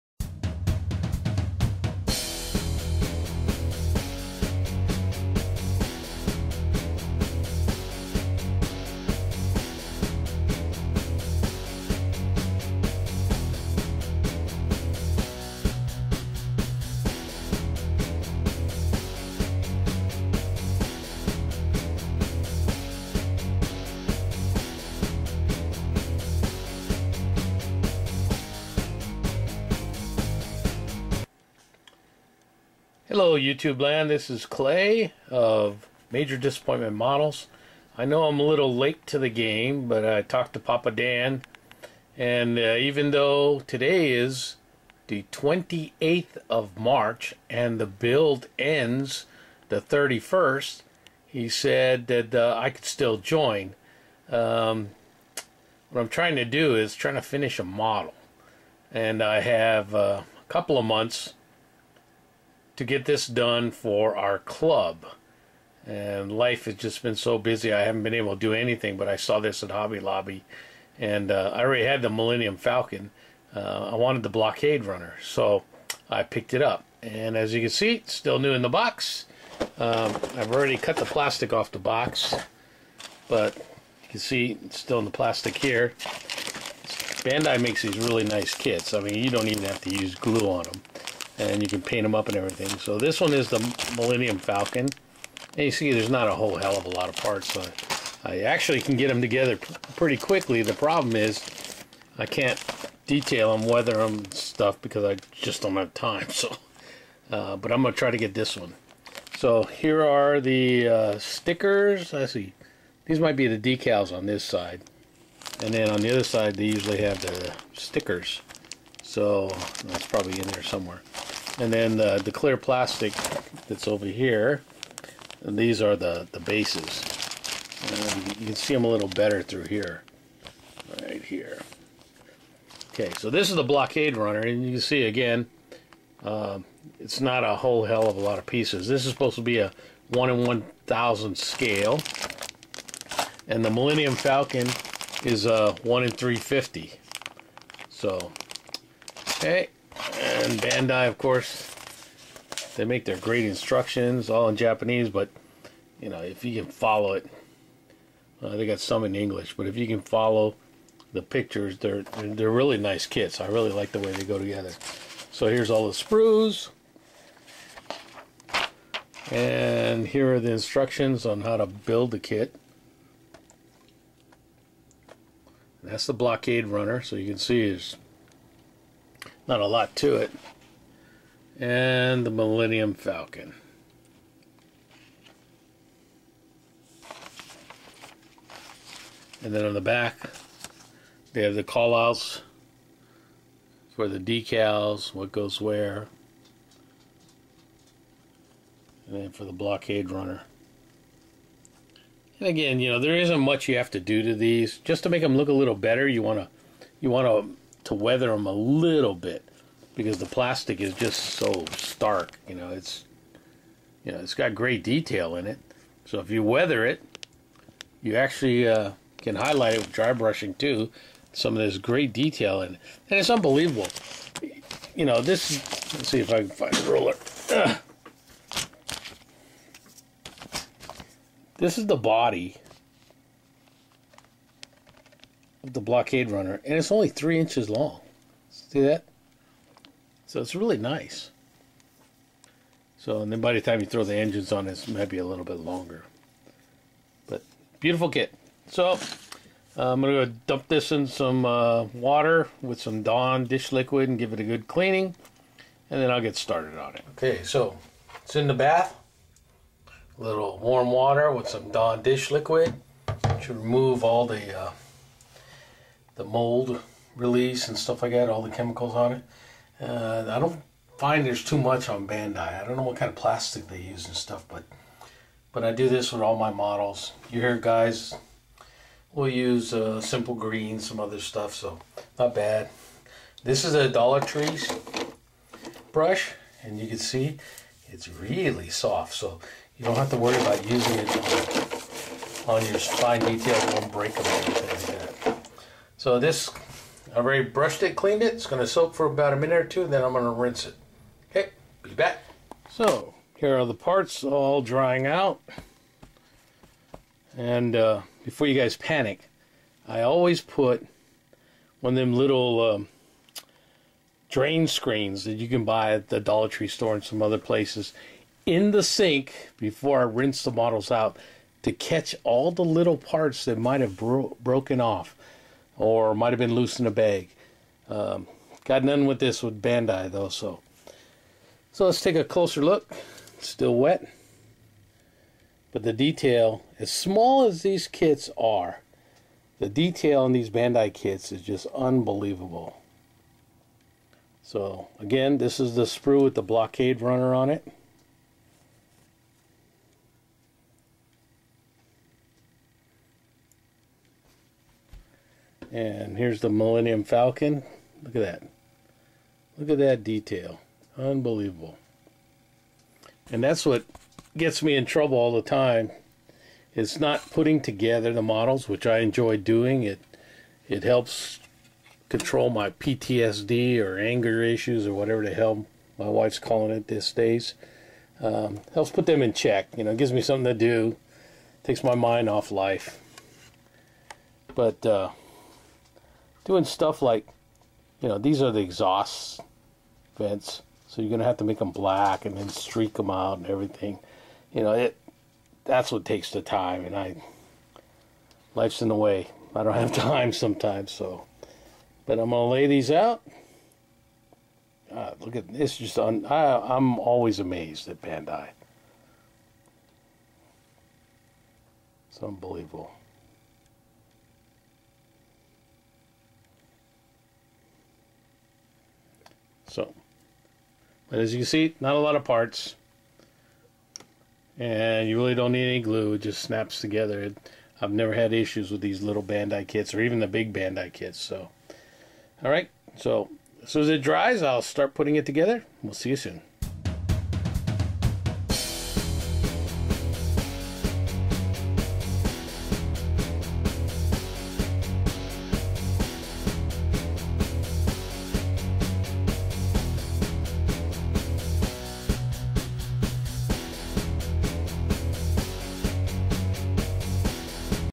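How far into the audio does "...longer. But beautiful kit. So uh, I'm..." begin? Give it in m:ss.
4:05.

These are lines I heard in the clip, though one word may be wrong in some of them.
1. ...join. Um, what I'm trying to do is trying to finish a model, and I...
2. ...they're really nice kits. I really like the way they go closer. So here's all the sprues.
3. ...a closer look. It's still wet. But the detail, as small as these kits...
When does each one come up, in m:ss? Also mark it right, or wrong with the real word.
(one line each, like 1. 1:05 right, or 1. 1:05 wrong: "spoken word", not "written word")
1. 0:53 right
2. 2:42 wrong: "together", not "closer"
3. 5:32 right.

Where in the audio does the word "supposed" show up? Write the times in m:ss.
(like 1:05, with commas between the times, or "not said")
2:19.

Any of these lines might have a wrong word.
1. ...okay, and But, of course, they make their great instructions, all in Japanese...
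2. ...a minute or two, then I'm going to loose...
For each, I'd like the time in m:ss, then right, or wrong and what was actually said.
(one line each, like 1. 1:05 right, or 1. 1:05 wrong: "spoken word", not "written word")
1. 2:29 wrong: "Bandai", not "But"
2. 4:59 wrong: "rinse", not "loose".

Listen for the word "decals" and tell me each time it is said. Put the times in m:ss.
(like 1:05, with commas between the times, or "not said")
1:53, 3:14.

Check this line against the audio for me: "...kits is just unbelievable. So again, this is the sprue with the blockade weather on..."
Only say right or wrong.
wrong.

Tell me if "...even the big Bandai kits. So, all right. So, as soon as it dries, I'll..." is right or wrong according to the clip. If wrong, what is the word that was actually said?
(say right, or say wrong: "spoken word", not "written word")
right.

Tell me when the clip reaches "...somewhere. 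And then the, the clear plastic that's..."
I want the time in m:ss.
2:00.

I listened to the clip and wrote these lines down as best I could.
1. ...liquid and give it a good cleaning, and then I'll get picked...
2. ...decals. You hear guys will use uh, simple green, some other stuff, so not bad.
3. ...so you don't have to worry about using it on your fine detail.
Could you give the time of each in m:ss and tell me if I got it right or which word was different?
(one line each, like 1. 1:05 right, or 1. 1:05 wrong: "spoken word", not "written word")
1. 4:13 wrong: "started", not "picked"
2. 4:36 wrong: "models", not "decals"
3. 4:49 right.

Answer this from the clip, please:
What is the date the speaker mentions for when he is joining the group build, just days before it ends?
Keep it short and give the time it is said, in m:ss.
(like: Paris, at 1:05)
28th of March, at 0:45.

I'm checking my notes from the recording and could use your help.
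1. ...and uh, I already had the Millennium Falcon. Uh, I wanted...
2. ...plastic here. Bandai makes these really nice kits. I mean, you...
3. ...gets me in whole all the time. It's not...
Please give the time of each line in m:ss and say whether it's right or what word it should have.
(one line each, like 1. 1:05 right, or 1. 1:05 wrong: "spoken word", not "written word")
1. 1:10 right
2. 1:25 right
3. 6:04 wrong: "trouble", not "whole".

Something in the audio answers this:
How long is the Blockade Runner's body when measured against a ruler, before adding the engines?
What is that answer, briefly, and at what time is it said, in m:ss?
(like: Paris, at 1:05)
3 inches, at 3:57.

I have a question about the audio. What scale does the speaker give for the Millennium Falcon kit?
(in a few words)
1/350.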